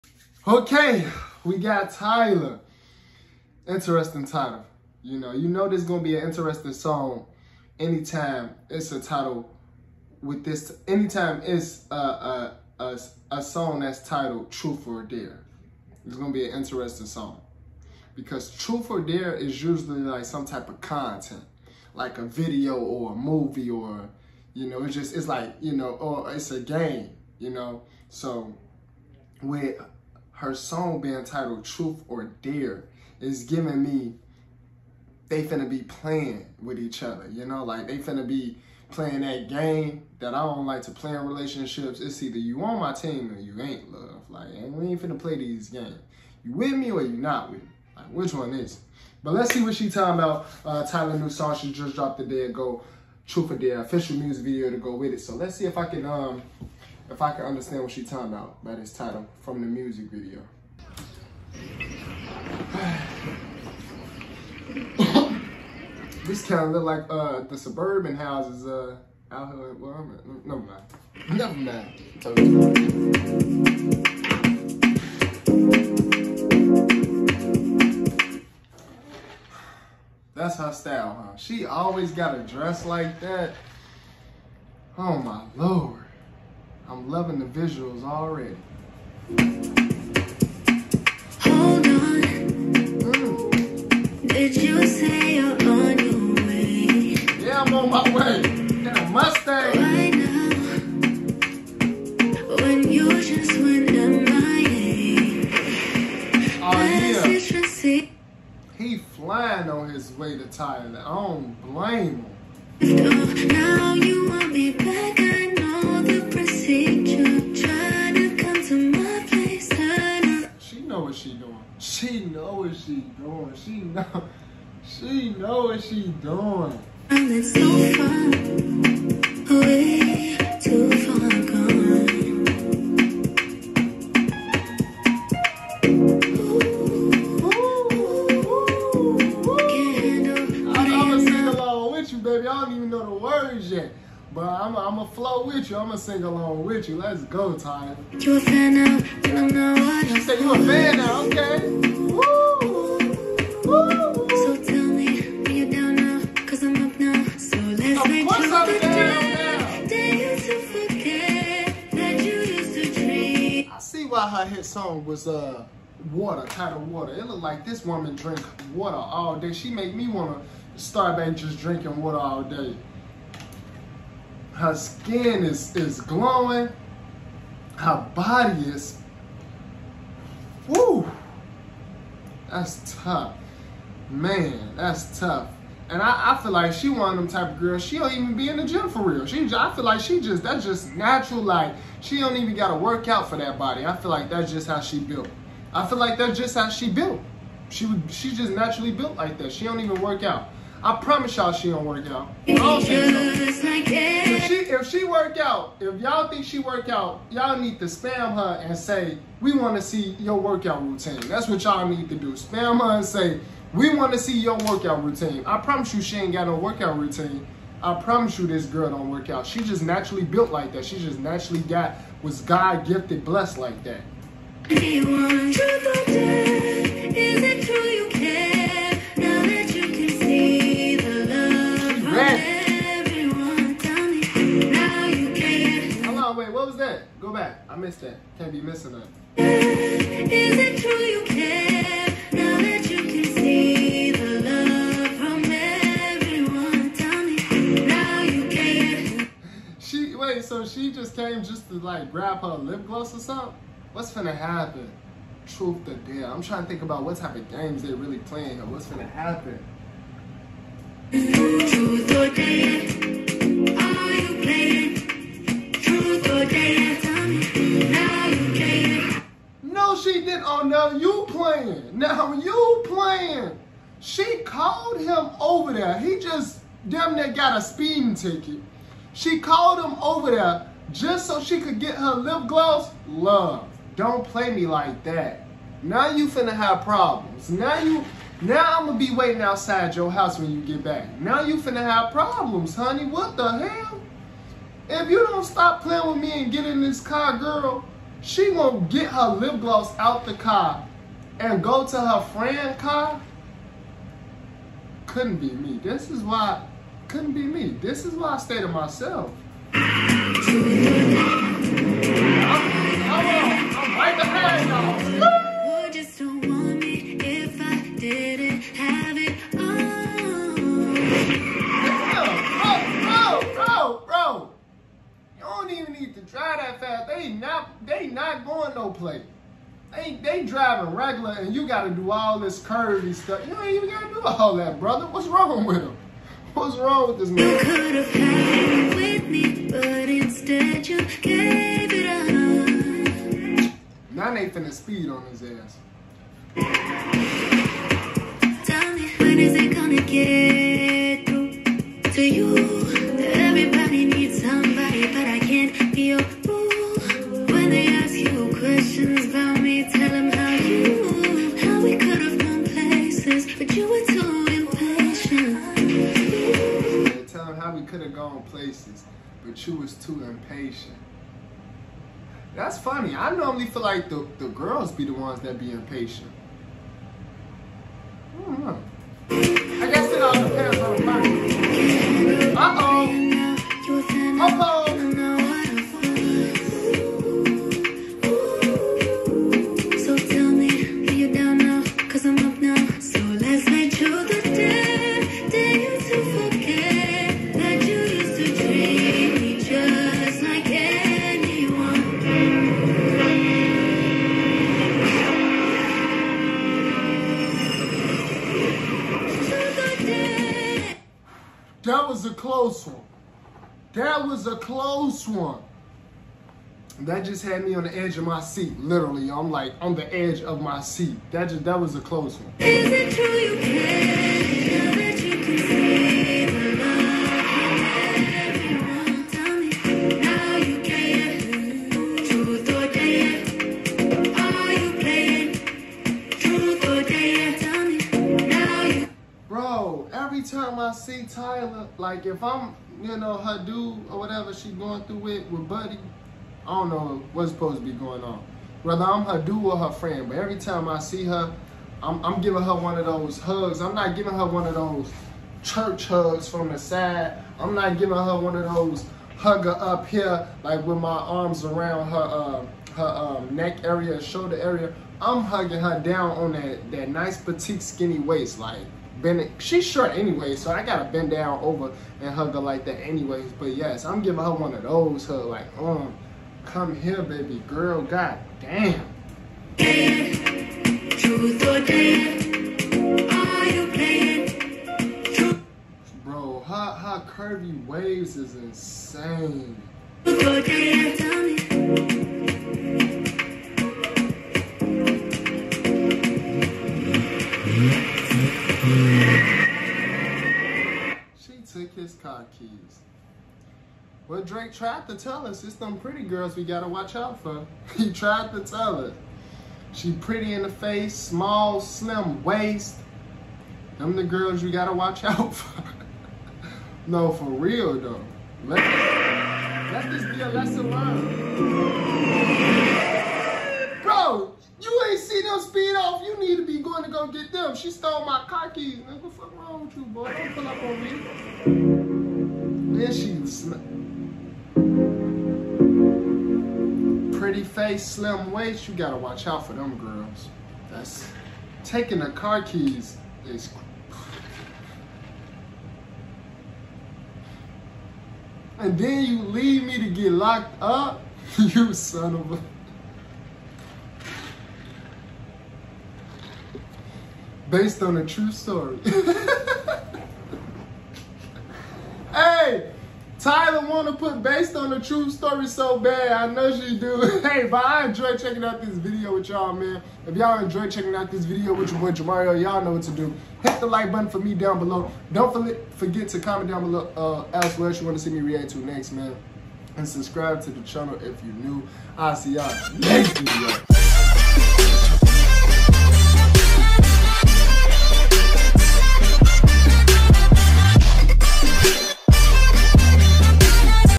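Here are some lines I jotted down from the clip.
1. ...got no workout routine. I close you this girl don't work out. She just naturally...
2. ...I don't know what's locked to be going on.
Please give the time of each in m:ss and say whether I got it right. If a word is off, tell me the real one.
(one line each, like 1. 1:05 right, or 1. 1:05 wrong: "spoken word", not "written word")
1. 3:36 wrong: "promise", not "close"
2. 7:26 wrong: "supposed", not "locked".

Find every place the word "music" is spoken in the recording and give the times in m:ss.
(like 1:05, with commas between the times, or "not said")
0:54, 0:59.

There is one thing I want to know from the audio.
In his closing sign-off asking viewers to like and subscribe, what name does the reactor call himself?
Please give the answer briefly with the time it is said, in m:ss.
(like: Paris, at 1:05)
Jamario, at 9:32.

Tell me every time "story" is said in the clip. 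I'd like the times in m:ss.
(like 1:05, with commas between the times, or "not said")
9:18, 9:25.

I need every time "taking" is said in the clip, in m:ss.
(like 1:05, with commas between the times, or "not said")
9:01.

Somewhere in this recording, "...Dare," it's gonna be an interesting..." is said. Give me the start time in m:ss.
0:15.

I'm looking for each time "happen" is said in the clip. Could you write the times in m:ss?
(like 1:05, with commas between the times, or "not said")
4:14, 4:19.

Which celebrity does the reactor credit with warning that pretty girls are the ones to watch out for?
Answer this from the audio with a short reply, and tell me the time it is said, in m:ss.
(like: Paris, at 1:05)
Drake, at 8:24.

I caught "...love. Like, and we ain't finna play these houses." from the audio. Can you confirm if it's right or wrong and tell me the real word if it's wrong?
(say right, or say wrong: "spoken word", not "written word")
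wrong: "games", not "houses".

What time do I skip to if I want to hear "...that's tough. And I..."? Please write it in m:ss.
3:04.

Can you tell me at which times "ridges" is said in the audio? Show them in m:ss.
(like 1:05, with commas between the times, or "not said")
not said.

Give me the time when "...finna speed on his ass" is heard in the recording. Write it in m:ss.
5:44.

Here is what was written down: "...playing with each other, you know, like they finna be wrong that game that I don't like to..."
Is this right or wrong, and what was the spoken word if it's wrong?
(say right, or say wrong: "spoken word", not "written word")
wrong: "playing", not "wrong".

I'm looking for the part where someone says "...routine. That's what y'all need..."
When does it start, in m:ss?
3:30.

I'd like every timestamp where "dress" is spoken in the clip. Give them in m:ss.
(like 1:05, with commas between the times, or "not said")
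1:22.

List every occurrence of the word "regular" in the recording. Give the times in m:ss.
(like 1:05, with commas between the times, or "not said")
5:30.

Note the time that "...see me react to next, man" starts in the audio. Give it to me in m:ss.
9:38.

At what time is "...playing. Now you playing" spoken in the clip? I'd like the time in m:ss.
4:31.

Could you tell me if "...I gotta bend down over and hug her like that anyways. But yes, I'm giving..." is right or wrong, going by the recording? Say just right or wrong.
right.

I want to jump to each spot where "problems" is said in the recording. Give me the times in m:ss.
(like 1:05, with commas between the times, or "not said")
4:46, 4:52.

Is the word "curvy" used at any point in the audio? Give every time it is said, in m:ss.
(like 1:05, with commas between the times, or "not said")
5:32, 8:07.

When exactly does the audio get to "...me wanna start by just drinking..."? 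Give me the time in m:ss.
2:49.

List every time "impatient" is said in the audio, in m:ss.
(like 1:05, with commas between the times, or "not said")
6:10, 6:15.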